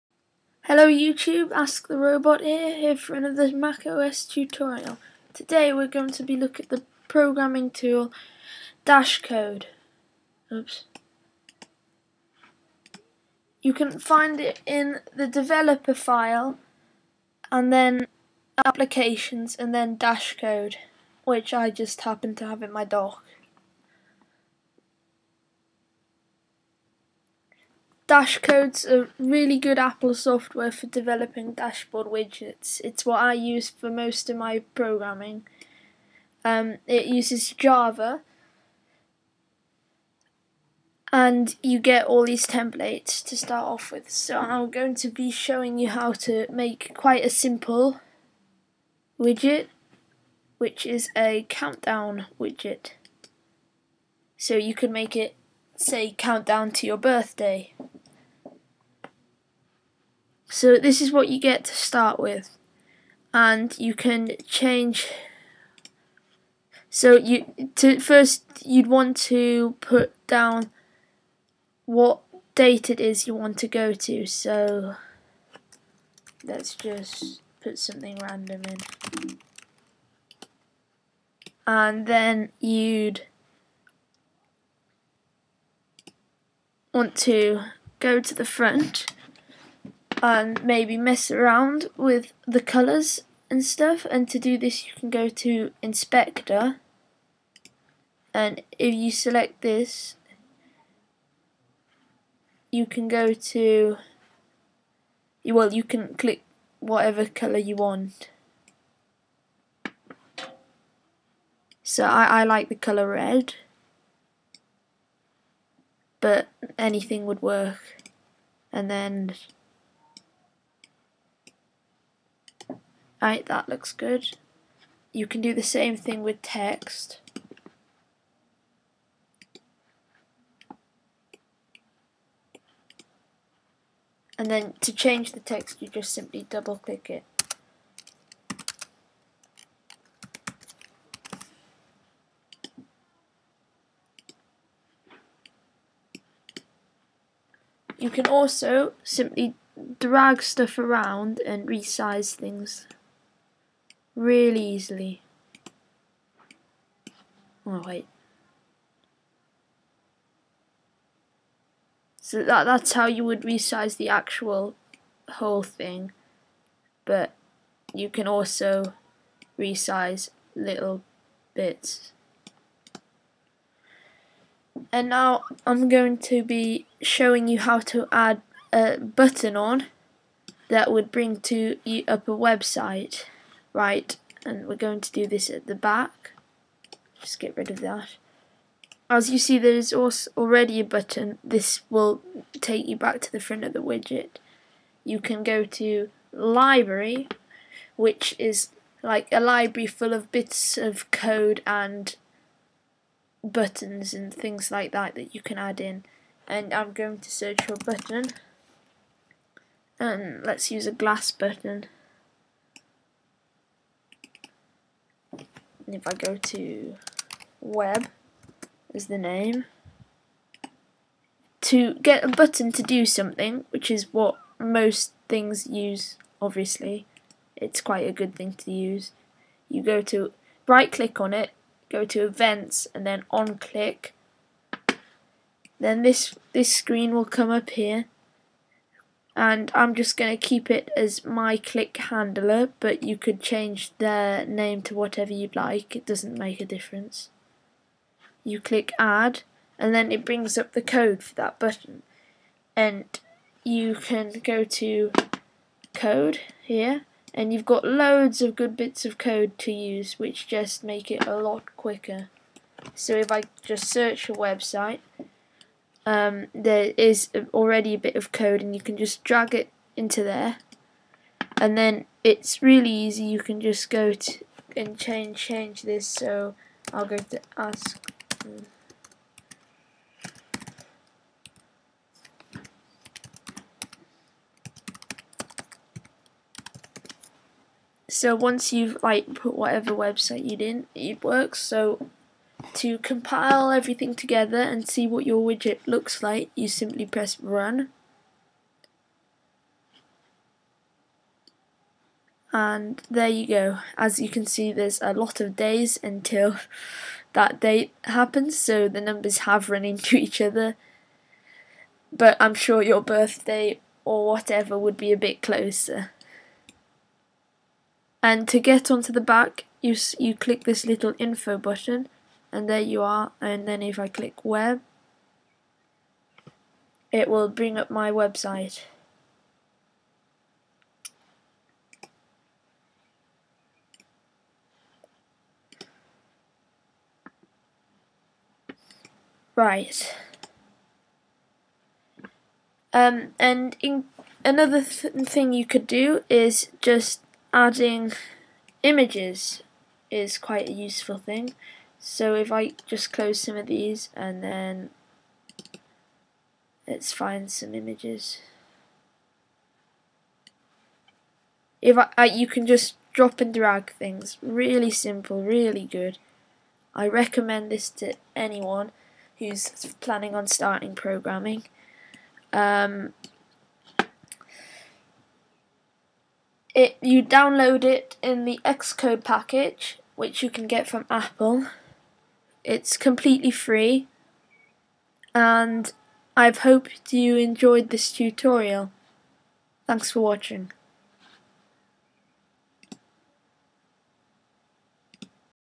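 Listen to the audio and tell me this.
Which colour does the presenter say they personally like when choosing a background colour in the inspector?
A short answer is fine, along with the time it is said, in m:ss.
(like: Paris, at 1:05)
Red, at 1:53.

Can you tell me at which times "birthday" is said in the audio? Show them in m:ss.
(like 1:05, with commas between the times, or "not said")
0:56, 5:13.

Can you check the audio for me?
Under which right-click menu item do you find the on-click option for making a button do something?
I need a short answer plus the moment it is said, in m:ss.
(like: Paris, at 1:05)
Events, at 3:52.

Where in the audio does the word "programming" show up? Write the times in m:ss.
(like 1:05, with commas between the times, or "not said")
0:07, 0:34, 6:10.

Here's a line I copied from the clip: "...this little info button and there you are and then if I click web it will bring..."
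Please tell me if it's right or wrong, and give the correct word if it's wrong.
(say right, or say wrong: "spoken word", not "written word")
right.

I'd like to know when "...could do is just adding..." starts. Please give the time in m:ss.
5:45.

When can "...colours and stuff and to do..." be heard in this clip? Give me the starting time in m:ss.
1:32.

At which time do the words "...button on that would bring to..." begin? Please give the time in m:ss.
2:58.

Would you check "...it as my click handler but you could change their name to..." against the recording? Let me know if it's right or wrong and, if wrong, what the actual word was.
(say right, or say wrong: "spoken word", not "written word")
right.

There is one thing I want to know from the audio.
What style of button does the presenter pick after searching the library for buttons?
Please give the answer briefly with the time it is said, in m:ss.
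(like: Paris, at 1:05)
Glass button, at 3:30.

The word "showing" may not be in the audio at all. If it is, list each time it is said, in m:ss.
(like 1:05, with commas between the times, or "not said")
0:45, 2:57.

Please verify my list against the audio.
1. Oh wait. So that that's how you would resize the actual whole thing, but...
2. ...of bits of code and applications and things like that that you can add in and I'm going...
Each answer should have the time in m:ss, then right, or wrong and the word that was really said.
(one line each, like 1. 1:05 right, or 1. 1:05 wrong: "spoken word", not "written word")
1. 2:37 right
2. 3:20 wrong: "buttons", not "applications".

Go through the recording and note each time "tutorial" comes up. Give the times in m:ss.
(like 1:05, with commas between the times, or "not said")
0:04, 6:28.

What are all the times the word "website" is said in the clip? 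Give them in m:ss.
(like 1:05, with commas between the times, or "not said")
3:02, 4:24, 4:49, 5:28.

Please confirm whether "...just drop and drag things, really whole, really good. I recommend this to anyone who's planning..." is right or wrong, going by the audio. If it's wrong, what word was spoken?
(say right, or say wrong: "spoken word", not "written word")
wrong: "simple", not "whole".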